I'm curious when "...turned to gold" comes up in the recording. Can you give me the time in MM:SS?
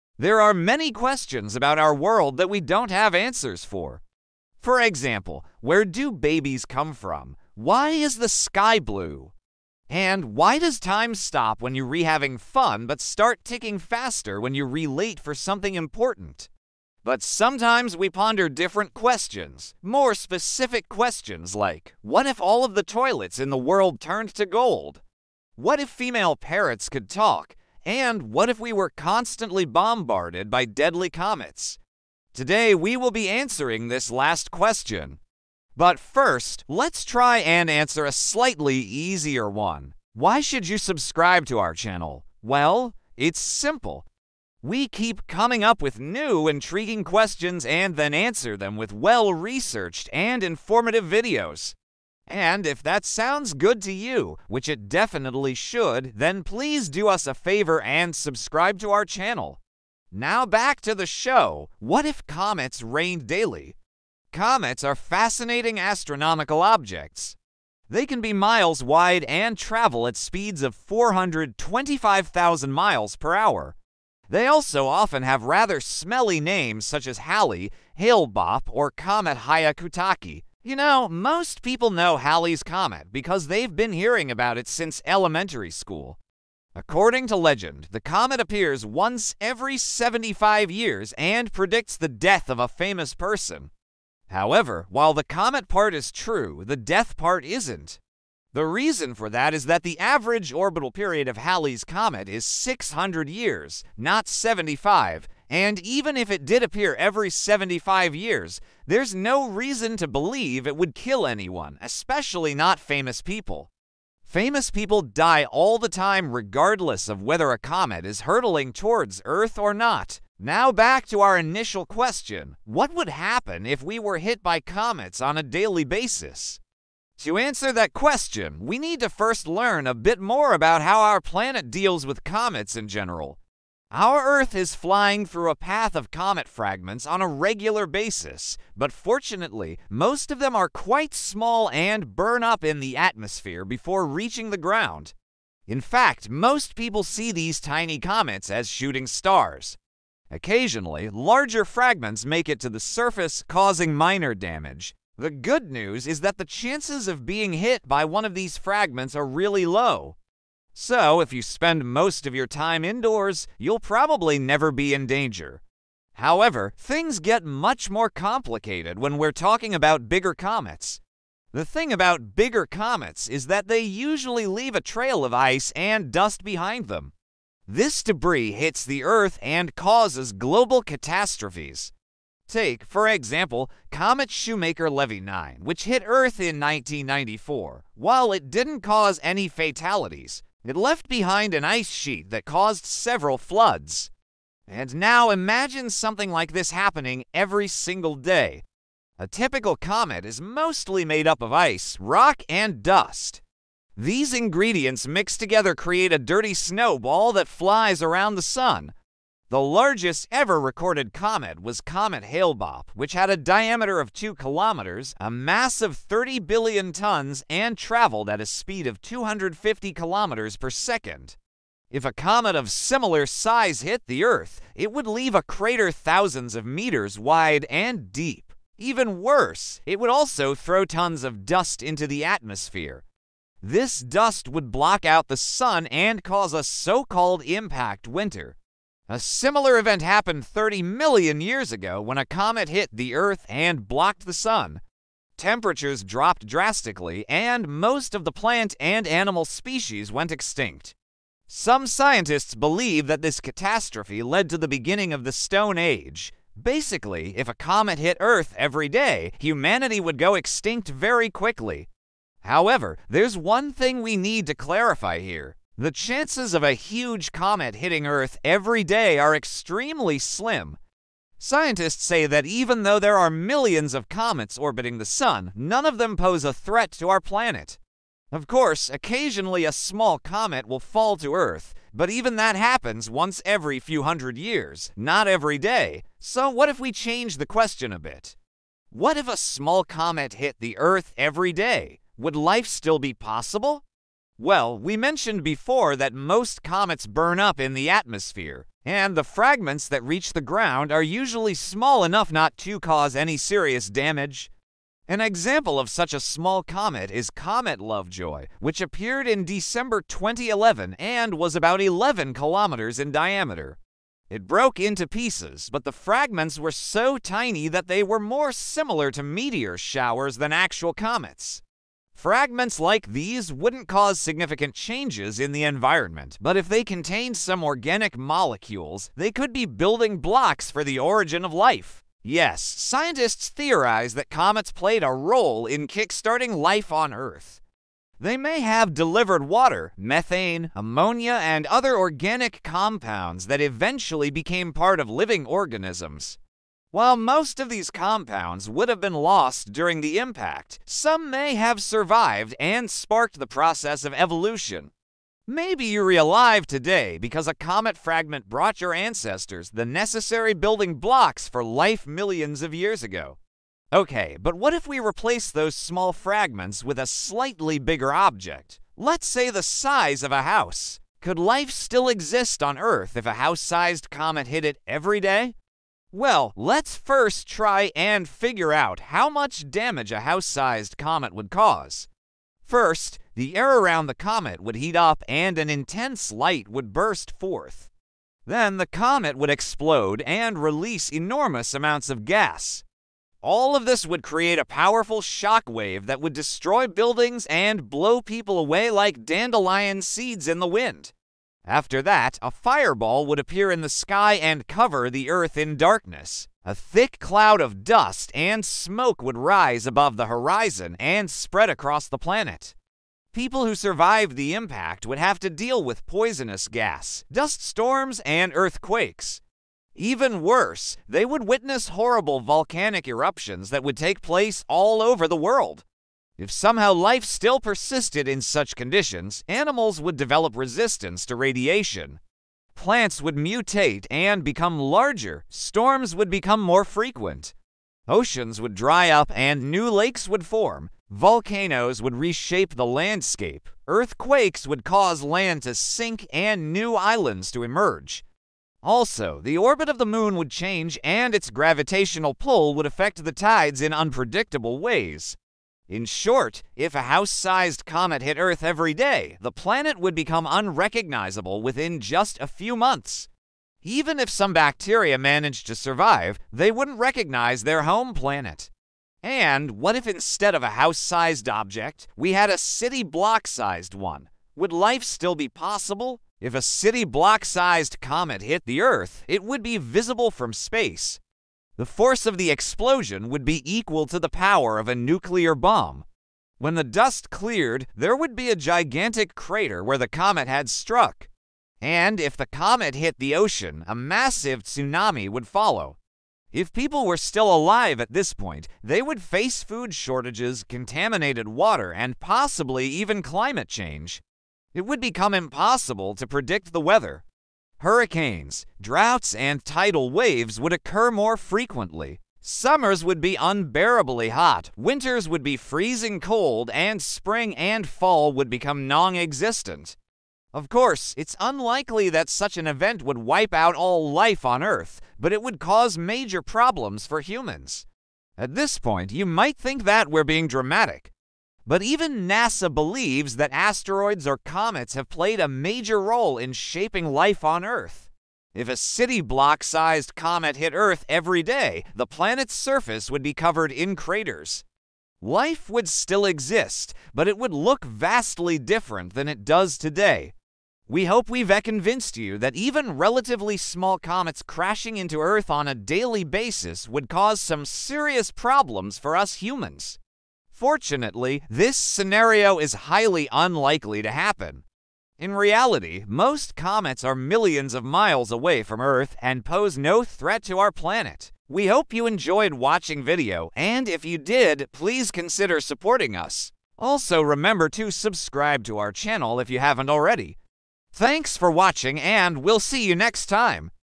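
00:23.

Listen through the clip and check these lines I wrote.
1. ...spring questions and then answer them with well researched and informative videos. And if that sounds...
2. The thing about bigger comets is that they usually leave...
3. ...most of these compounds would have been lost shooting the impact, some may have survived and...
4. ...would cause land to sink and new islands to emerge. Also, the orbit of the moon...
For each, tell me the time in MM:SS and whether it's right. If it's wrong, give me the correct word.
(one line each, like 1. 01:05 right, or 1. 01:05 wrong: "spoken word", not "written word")
1. 00:46 wrong: "intriguing", not "spring"
2. 02:51 right
3. 05:47 wrong: "during", not "shooting"
4. 07:24 right.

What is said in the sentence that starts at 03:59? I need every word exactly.
A similar event happened 30 million years ago when a comet hit the Earth and blocked the Sun.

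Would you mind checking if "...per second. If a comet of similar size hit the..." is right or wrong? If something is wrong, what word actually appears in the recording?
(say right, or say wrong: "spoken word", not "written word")
right.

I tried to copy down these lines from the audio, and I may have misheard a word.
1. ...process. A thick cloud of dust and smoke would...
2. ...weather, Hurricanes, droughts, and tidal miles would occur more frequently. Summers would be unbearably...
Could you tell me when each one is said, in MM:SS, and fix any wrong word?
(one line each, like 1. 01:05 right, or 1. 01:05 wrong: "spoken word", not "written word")
1. 06:45 wrong: "darkness", not "process"
2. 08:26 wrong: "waves", not "miles".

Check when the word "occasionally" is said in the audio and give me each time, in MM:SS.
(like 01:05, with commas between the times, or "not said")
02:30, 04:38.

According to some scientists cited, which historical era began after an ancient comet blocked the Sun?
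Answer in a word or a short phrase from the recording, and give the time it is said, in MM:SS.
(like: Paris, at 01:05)
the Stone Age, at 04:15.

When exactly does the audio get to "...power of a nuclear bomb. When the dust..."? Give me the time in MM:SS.
08:04.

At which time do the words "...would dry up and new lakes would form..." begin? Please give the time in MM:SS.
07:18.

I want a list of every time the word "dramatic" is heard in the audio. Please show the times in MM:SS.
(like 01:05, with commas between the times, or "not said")
08:50.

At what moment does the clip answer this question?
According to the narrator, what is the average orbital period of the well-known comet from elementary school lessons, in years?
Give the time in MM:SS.
01:42.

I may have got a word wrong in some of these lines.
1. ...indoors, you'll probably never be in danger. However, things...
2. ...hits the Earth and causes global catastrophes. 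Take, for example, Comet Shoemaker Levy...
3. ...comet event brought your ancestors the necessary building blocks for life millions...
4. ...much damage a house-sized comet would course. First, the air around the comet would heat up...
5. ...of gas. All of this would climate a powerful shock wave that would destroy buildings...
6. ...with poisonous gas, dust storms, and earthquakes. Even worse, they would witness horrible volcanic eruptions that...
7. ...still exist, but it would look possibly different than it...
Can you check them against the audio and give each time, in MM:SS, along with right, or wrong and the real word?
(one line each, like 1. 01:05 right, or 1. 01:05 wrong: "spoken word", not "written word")
1. 02:42 right
2. 02:58 right
3. 05:57 wrong: "fragment", not "event"
4. 06:19 wrong: "cause", not "course"
5. 06:32 wrong: "create", not "climate"
6. 06:55 right
7. 09:05 wrong: "vastly", not "possibly".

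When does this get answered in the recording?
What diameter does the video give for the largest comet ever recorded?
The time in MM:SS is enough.
03:34.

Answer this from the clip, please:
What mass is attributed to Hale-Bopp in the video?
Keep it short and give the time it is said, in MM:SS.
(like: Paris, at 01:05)
30 billion tons, at 03:35.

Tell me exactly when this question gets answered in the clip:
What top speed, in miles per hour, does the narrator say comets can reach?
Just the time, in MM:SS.
01:10.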